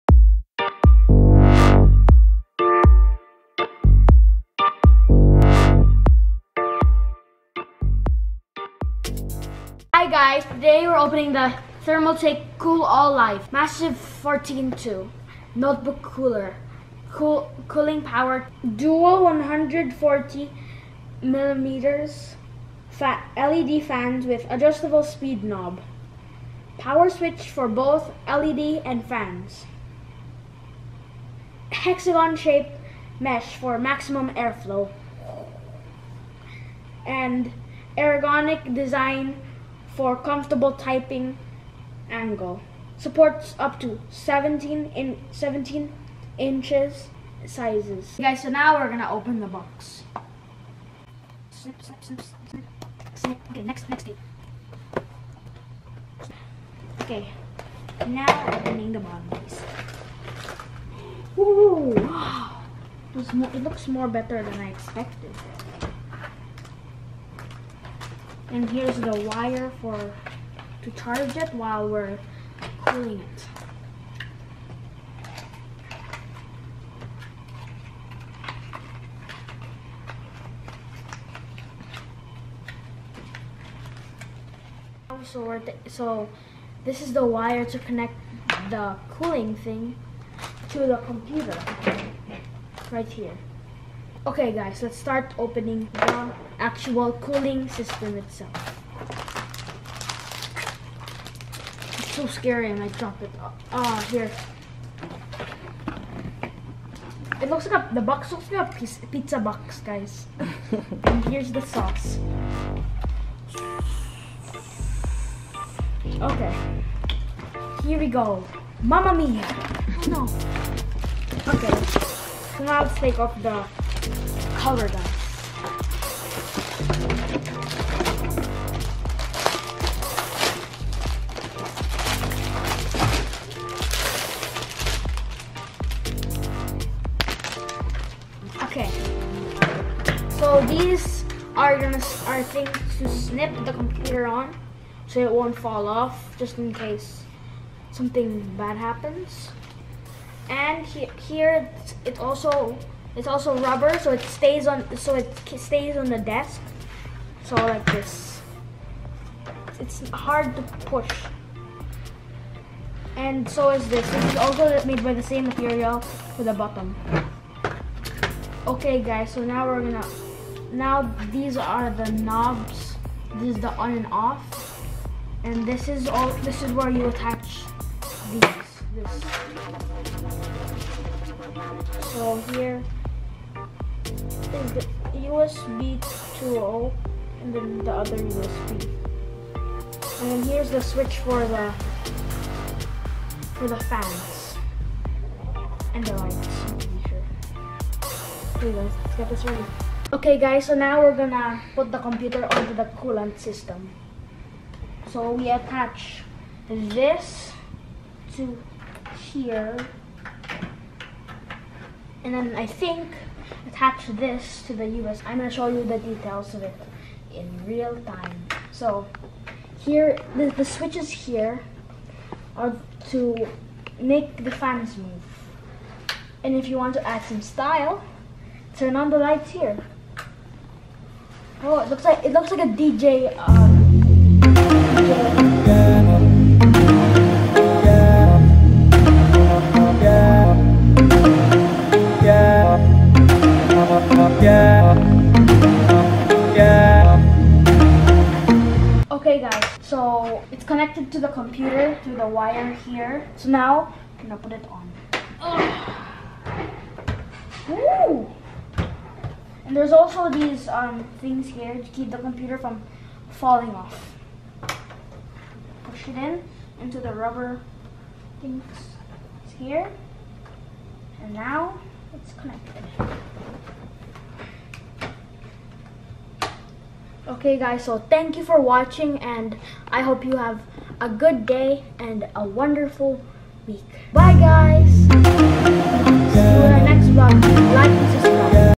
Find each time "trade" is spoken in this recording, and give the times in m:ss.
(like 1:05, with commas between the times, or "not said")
not said.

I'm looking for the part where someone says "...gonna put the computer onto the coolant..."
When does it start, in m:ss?
3:21.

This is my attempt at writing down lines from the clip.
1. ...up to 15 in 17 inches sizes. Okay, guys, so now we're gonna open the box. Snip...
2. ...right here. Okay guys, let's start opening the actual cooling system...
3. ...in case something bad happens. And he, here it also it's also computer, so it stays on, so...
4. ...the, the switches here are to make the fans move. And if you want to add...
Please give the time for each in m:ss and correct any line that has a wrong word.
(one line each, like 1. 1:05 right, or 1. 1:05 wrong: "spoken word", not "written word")
1. 0:43 wrong: "17", not "15"
2. 1:32 right
3. 2:26 wrong: "rubber", not "computer"
4. 3:40 right.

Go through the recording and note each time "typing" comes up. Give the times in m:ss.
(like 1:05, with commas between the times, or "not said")
0:40.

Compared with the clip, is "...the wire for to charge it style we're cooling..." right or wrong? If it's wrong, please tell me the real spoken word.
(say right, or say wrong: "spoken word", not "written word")
wrong: "while", not "style".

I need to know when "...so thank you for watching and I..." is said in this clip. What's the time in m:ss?
4:37.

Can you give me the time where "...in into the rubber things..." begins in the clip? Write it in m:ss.
4:26.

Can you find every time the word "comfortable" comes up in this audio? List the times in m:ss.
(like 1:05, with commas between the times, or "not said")
0:40.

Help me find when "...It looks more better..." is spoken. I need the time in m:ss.
1:03.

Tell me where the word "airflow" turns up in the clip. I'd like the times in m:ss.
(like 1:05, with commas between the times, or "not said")
0:34.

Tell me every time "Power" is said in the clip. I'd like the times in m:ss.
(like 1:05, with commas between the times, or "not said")
0:18, 0:26.